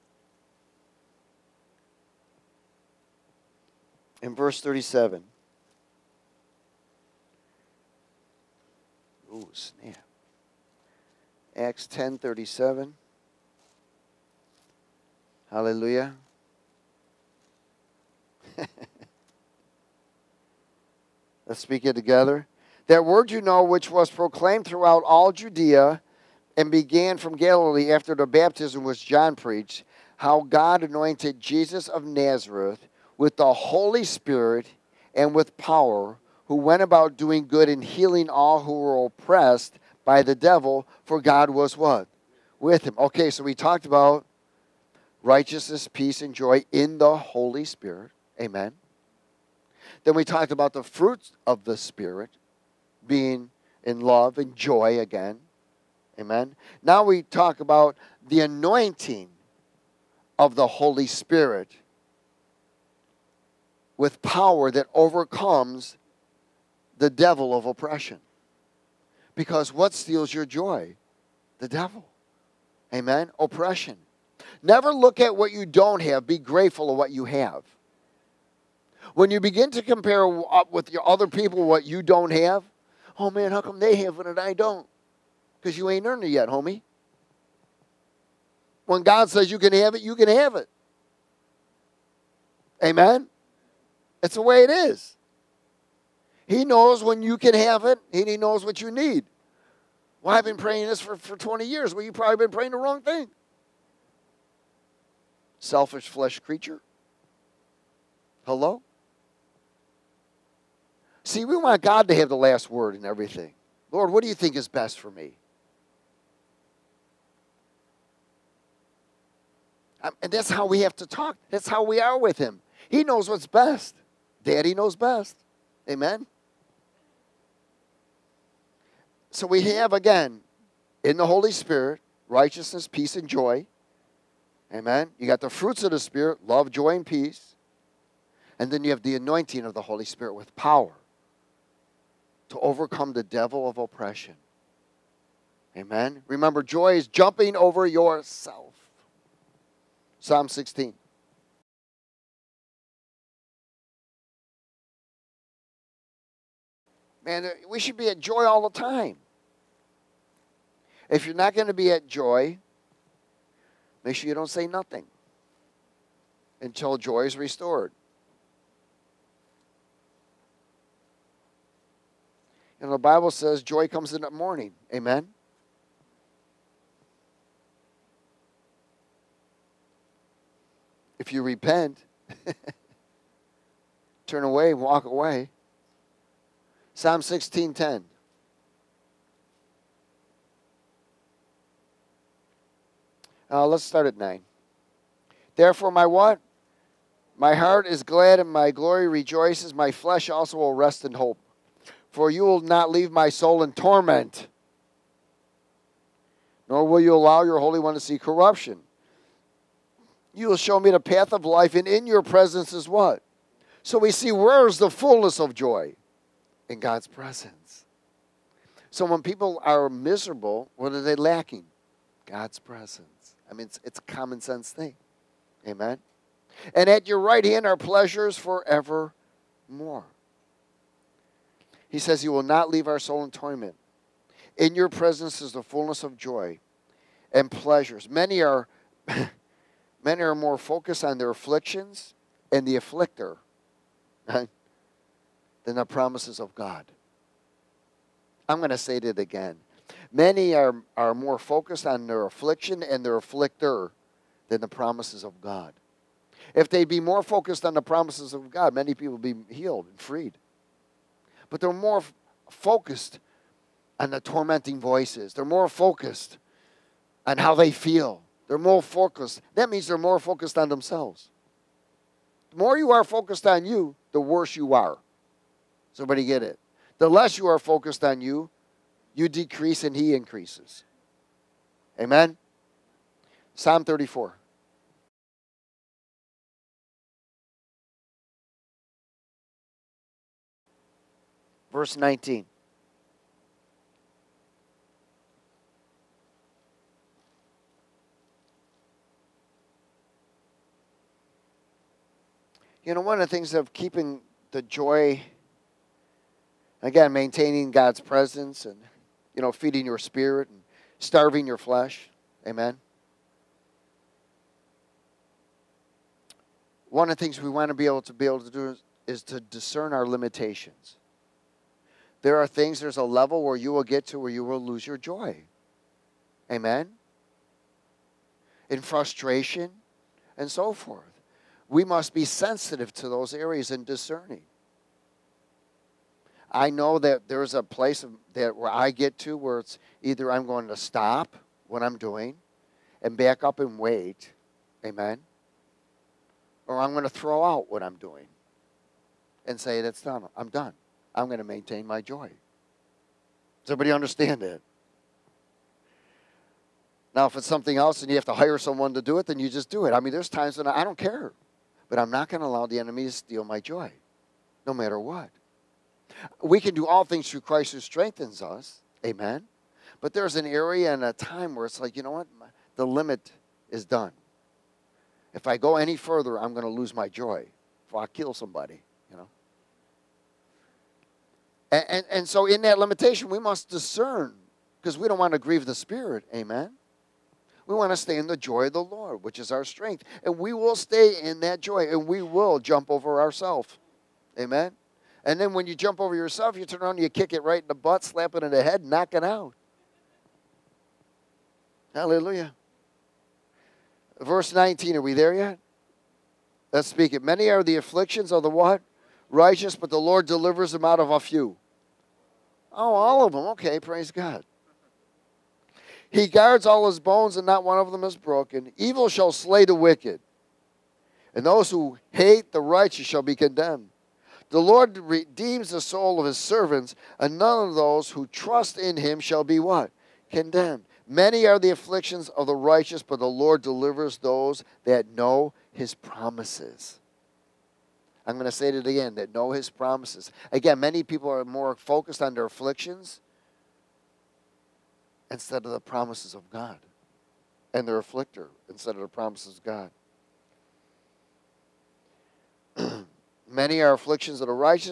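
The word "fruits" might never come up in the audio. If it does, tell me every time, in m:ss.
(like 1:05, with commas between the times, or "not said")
0:50, 2:15.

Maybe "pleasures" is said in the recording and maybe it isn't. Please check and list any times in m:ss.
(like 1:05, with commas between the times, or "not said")
3:47, 3:57.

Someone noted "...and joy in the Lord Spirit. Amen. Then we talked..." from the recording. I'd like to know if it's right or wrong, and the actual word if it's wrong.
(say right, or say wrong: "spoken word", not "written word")
wrong: "Holy", not "Lord".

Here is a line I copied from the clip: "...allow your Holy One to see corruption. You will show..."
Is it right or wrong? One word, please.
right.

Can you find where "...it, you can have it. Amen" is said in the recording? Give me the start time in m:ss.
1:29.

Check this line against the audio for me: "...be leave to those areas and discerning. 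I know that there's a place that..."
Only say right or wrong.
wrong.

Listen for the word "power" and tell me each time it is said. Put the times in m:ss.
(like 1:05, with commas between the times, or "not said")
0:35, 1:04, 2:20.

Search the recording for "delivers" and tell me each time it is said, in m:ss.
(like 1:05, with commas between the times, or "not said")
6:50, 7:13.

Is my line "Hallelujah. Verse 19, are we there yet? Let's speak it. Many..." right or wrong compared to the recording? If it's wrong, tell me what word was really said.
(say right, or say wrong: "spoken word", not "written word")
right.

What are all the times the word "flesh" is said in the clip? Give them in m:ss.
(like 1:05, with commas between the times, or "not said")
1:46, 3:19, 5:11.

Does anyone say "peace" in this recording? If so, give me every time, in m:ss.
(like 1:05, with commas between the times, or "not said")
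0:45, 2:12, 2:17.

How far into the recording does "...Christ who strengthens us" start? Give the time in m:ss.
6:07.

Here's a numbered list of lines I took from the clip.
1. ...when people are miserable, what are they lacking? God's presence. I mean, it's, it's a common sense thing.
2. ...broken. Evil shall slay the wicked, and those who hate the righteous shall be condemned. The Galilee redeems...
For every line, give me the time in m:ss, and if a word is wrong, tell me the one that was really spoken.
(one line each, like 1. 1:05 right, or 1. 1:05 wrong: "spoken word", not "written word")
1. 3:39 right
2. 6:58 wrong: "Lord", not "Galilee".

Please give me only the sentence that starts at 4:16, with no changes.
If they'd be more focused on the promises of God, many people would be healed and freed.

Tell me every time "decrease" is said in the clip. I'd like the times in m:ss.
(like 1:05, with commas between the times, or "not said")
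4:39.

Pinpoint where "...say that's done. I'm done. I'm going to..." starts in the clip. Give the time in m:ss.
5:49.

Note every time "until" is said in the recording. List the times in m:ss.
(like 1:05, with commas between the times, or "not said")
2:46.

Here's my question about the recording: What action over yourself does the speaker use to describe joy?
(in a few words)
Jumping.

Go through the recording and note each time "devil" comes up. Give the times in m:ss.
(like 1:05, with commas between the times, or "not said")
0:40, 1:07, 1:11, 2:23.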